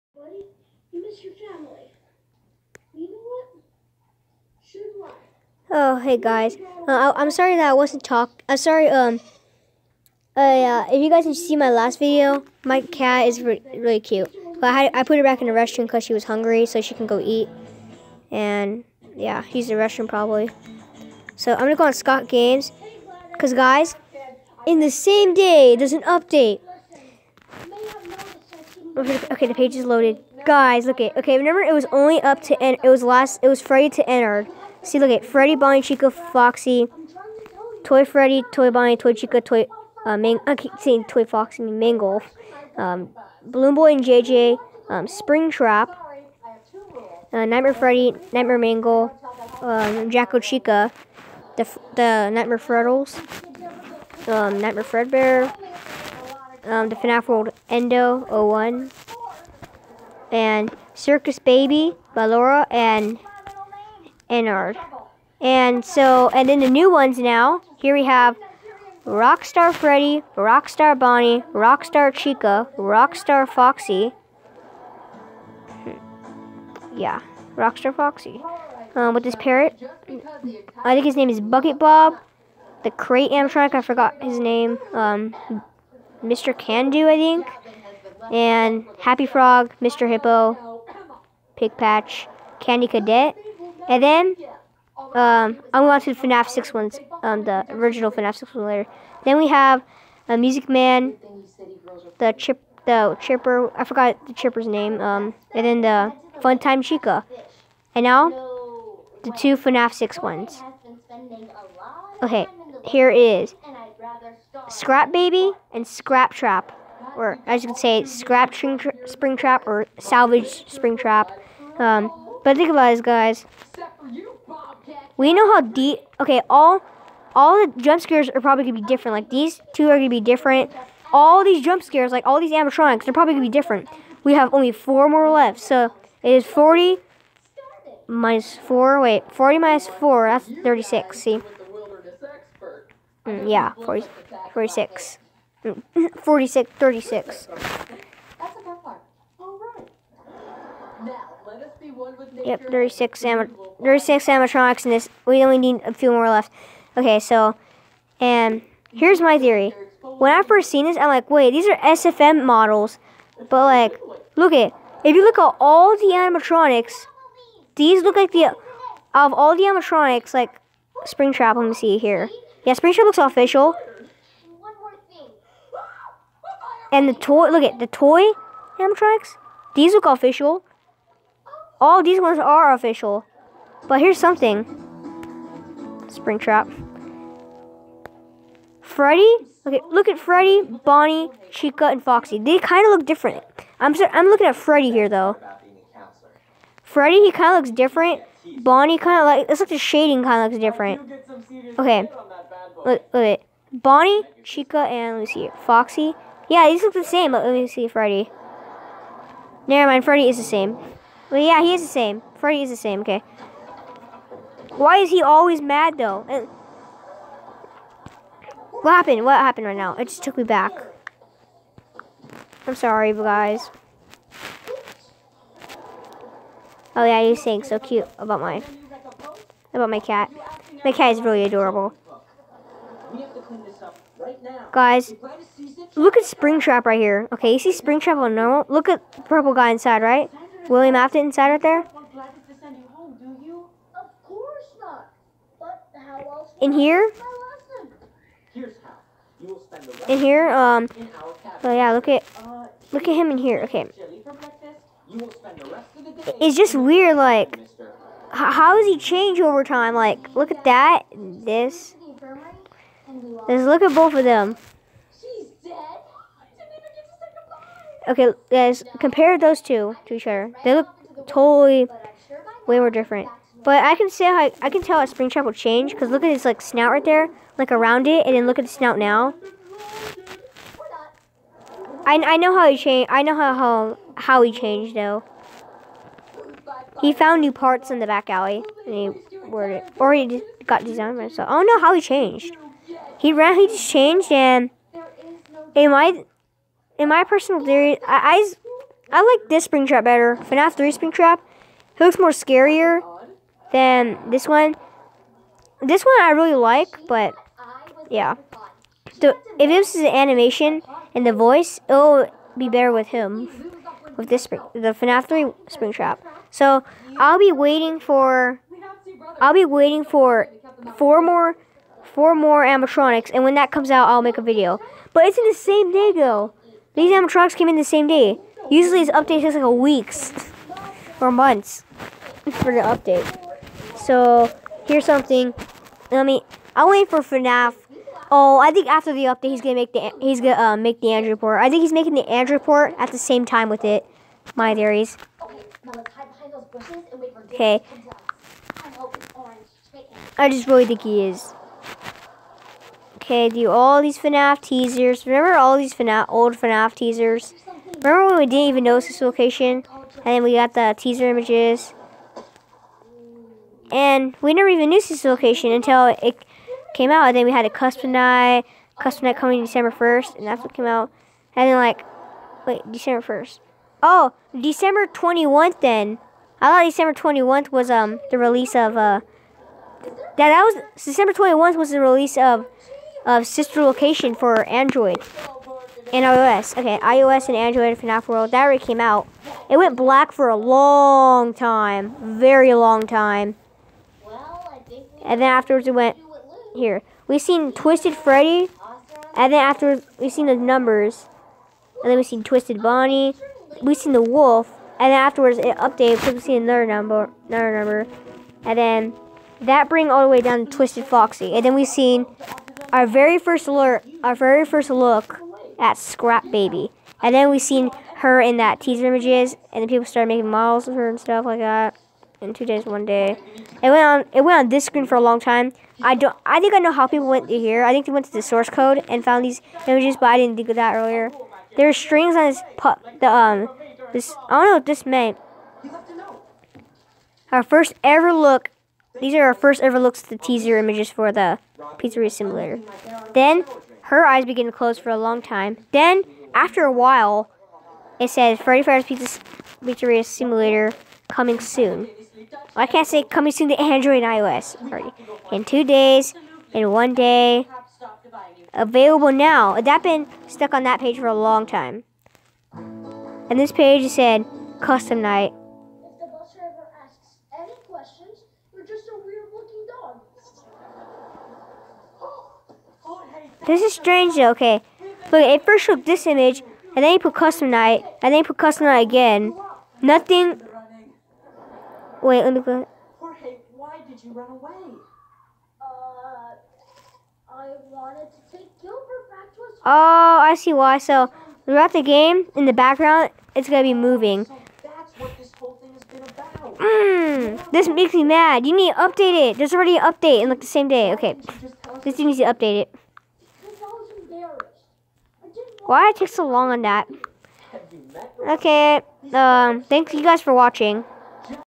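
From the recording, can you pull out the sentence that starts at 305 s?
This one I really like, but yeah.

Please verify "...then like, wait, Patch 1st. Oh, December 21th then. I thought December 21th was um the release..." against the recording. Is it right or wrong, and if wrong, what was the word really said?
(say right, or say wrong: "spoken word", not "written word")
wrong: "December", not "Patch".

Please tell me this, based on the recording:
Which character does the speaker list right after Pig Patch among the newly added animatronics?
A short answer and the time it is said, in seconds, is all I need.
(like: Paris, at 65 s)
Candy Cadet, at 92 s.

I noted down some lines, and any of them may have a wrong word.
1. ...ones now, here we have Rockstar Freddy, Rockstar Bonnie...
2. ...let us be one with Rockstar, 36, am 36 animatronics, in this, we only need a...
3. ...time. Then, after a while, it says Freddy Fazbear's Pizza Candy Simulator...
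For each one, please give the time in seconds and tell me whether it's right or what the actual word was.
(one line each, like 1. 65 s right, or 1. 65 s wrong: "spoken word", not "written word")
1. 66 s right
2. 151 s wrong: "Yep", not "Rockstar"
3. 445 s wrong: "Pizzeria", not "Candy".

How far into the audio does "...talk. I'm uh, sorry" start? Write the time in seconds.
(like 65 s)
8 s.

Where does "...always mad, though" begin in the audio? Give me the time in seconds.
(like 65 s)
215 s.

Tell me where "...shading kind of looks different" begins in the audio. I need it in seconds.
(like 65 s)
199 s.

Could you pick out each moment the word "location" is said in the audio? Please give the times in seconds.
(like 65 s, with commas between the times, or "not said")
359 s, 365 s, 383 s.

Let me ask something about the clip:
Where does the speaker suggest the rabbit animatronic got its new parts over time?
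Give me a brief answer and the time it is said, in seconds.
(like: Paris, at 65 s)
back alley, at 288 s.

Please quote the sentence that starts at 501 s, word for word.
Okay, this thing needs to update it.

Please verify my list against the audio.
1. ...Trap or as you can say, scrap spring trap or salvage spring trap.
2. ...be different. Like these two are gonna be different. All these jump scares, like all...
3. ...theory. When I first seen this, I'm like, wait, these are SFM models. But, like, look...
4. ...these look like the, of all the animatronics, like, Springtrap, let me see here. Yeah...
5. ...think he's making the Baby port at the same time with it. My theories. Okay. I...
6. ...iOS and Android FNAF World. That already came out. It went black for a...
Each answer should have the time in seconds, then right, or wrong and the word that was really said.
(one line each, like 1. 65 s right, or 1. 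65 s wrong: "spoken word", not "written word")
1. 116 s right
2. 128 s right
3. 159 s right
4. 167 s right
5. 341 s wrong: "Android", not "Baby"
6. 386 s right.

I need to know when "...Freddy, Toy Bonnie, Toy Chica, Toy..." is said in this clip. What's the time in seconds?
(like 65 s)
38 s.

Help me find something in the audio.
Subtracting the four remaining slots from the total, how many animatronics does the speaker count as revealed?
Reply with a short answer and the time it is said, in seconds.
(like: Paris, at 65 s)
36, at 140 s.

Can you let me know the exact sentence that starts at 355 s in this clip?
Remember all these FNAF, old FNAF teasers?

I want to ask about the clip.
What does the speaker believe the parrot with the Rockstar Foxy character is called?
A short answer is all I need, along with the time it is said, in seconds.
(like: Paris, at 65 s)
Bucket Bob, at 81 s.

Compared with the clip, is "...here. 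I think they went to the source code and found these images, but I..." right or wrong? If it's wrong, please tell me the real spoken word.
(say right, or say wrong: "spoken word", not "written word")
right.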